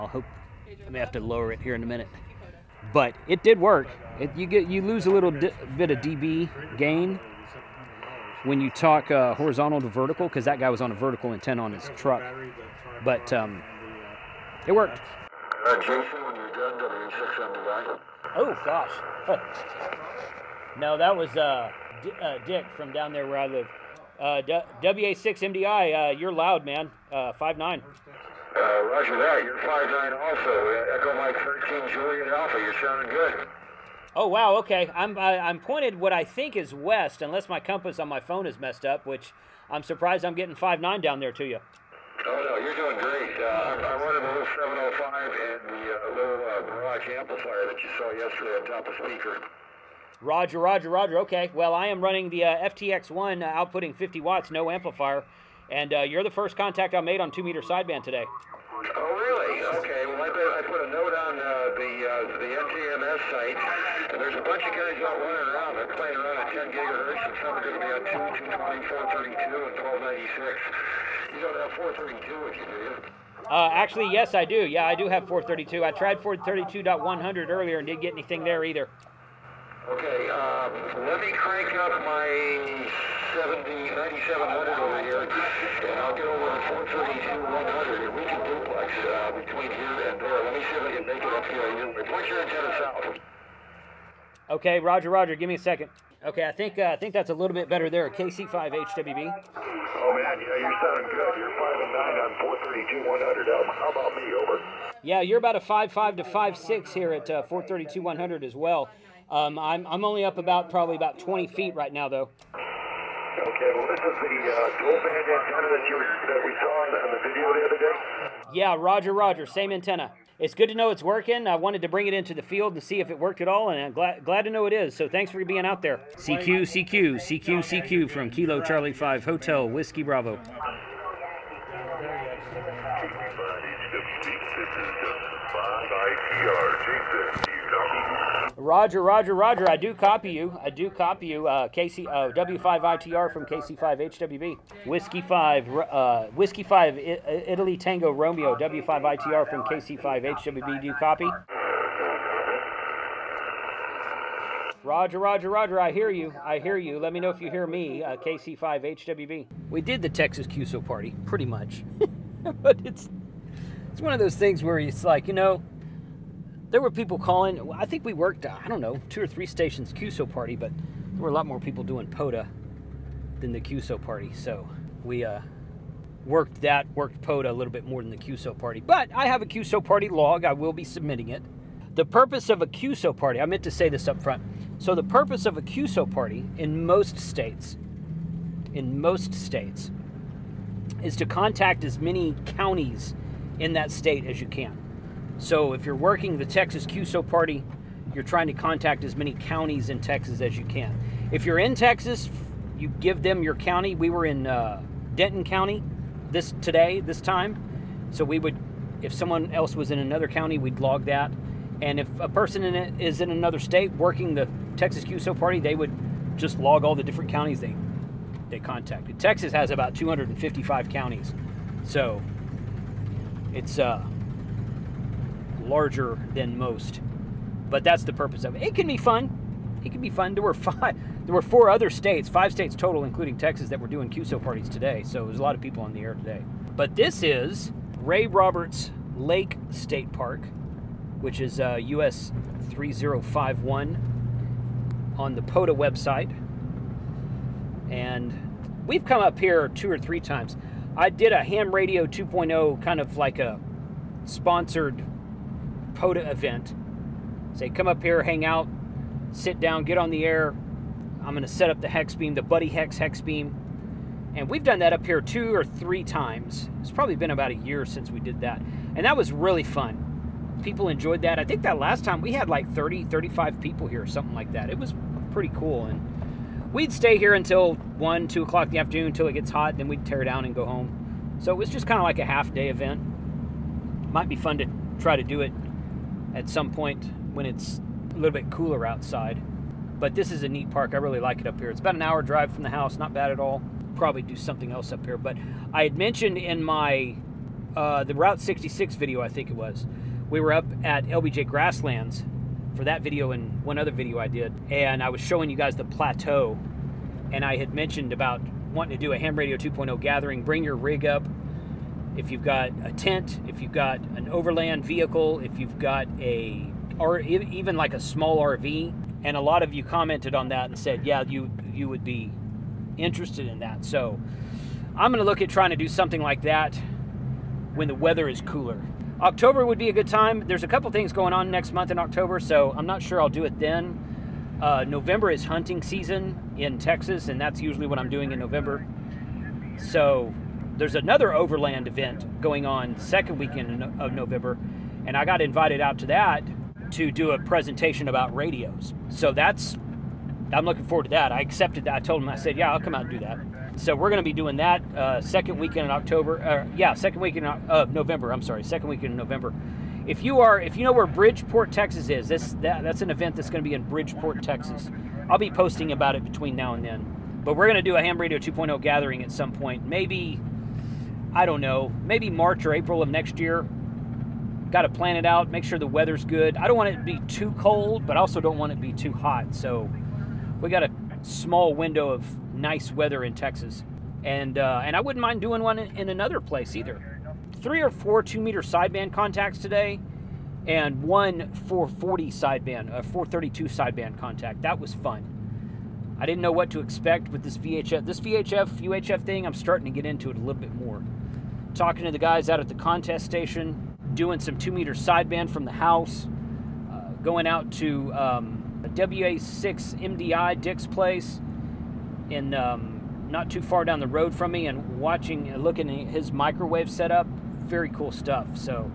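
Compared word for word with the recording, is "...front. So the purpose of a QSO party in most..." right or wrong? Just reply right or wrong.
right.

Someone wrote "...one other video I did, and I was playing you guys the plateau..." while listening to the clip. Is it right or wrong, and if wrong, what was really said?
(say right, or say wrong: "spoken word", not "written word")
wrong: "showing", not "playing".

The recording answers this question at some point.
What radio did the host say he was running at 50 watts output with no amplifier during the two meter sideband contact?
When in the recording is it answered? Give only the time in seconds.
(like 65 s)
52 s.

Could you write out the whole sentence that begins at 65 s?
They're playing around at 10 gigahertz, and some are going to be at 2, 220, 432, and 1296.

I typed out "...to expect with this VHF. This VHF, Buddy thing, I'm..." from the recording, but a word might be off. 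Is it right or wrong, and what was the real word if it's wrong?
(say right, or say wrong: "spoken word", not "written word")
wrong: "UHF", not "Buddy".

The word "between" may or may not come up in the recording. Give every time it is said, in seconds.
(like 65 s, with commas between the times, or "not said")
89 s, 366 s.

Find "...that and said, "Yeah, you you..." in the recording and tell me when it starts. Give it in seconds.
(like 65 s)
320 s.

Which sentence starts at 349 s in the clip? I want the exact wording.
So that's I'm looking forward to that.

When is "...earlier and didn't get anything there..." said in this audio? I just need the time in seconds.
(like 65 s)
77 s.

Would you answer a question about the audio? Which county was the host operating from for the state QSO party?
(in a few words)
Denton County.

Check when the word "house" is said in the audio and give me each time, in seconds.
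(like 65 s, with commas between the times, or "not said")
292 s, 405 s.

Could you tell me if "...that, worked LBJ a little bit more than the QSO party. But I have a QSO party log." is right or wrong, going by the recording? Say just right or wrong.
wrong.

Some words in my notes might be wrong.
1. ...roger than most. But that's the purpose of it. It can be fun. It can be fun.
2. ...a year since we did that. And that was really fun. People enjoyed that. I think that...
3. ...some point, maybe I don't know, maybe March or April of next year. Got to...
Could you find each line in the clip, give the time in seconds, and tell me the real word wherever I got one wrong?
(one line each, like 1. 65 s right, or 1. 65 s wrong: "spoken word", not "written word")
1. 225 s wrong: "larger", not "roger"
2. 267 s right
3. 369 s right.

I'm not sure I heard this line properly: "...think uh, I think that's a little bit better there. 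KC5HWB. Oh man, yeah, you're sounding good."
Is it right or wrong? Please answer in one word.
right.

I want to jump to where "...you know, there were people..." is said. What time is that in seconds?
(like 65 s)
165 s.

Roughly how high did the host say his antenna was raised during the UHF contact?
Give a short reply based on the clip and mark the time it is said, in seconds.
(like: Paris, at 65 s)
20 feet, at 111 s.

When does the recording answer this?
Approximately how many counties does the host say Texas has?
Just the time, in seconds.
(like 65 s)
219 s.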